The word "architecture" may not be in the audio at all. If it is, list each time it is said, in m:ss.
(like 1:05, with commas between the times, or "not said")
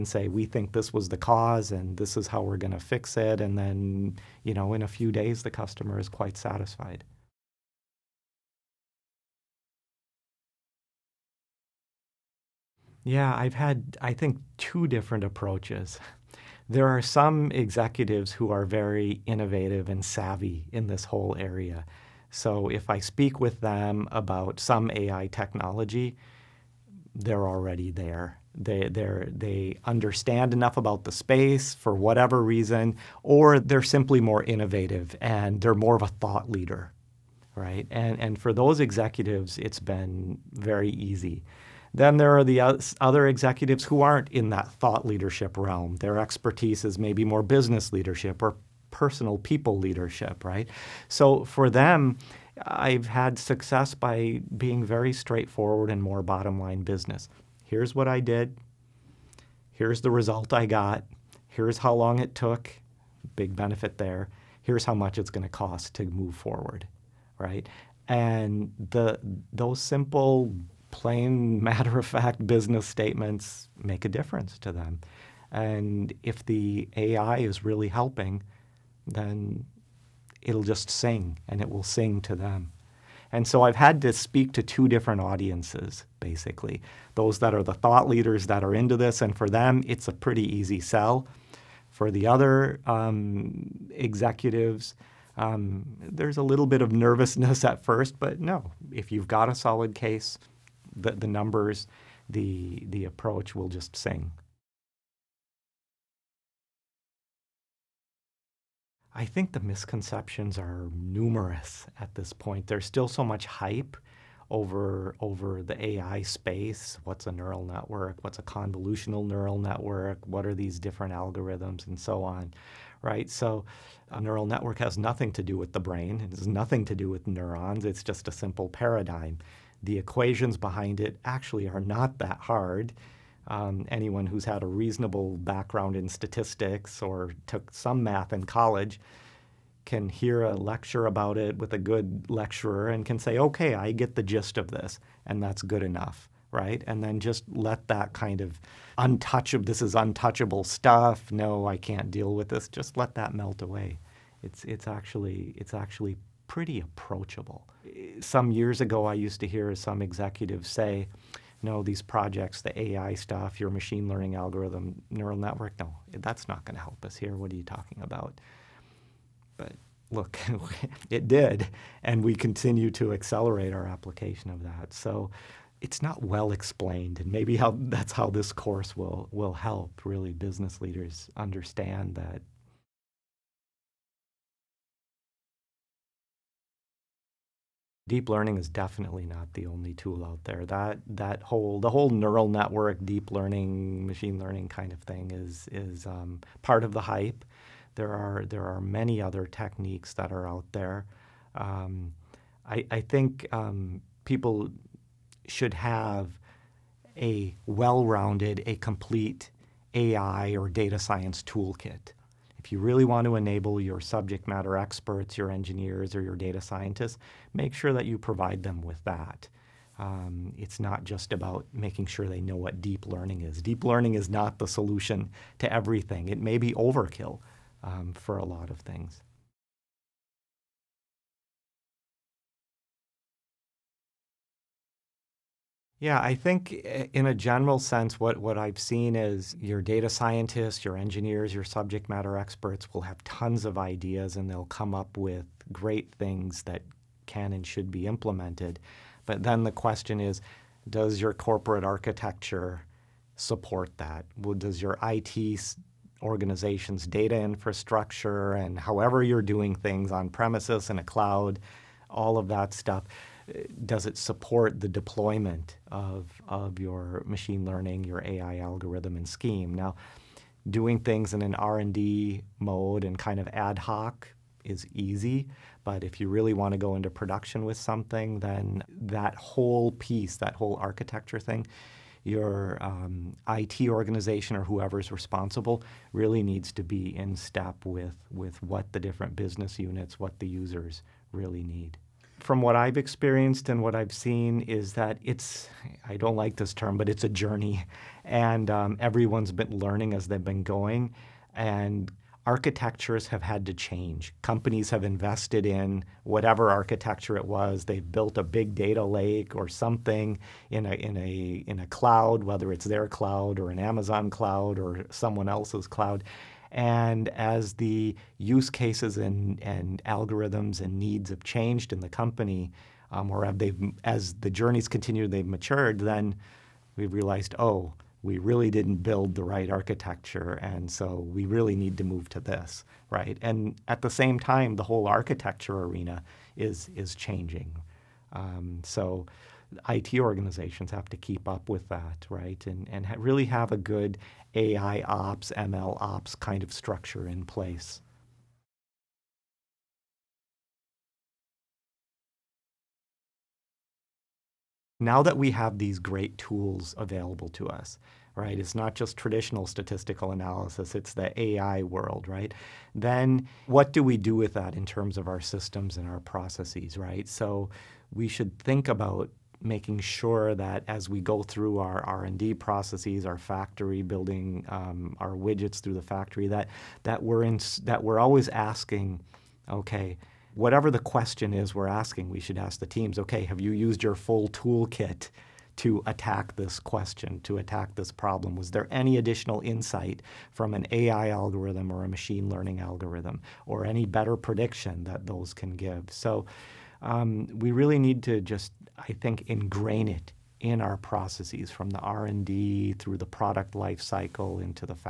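4:11, 4:40, 5:02, 5:06, 5:29, 5:35.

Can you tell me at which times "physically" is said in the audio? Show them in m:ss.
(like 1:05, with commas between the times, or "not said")
not said.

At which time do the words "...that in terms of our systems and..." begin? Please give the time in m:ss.
6:04.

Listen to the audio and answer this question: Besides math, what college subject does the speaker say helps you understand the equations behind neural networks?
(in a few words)
statistics.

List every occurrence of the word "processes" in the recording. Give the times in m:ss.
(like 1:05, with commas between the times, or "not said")
6:06, 6:12, 6:40.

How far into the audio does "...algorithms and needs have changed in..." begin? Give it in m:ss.
5:20.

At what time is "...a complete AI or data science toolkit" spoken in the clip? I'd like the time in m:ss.
3:28.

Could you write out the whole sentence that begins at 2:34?
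It's, it's, actually, it's actually pretty approachable.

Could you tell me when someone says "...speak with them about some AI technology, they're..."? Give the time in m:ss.
0:23.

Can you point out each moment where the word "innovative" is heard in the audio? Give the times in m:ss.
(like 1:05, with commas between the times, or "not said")
0:19, 0:34.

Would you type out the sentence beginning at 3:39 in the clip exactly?
Um, it's not just about making sure they know what deep learning is.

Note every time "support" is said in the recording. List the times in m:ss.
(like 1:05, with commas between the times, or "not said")
4:13, 4:24.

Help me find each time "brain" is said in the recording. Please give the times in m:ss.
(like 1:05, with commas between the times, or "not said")
2:05.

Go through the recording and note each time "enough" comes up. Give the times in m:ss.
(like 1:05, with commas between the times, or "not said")
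0:30, 2:25.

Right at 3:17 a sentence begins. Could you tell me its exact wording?
There are there are many other techniques that are out there.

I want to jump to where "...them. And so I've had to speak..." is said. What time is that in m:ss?
1:22.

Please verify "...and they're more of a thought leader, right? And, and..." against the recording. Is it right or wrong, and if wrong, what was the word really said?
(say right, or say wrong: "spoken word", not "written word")
right.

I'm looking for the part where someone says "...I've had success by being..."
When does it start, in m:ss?
0:52.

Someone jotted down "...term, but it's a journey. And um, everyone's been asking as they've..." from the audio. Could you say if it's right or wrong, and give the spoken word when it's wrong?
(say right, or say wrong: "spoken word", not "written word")
wrong: "learning", not "asking".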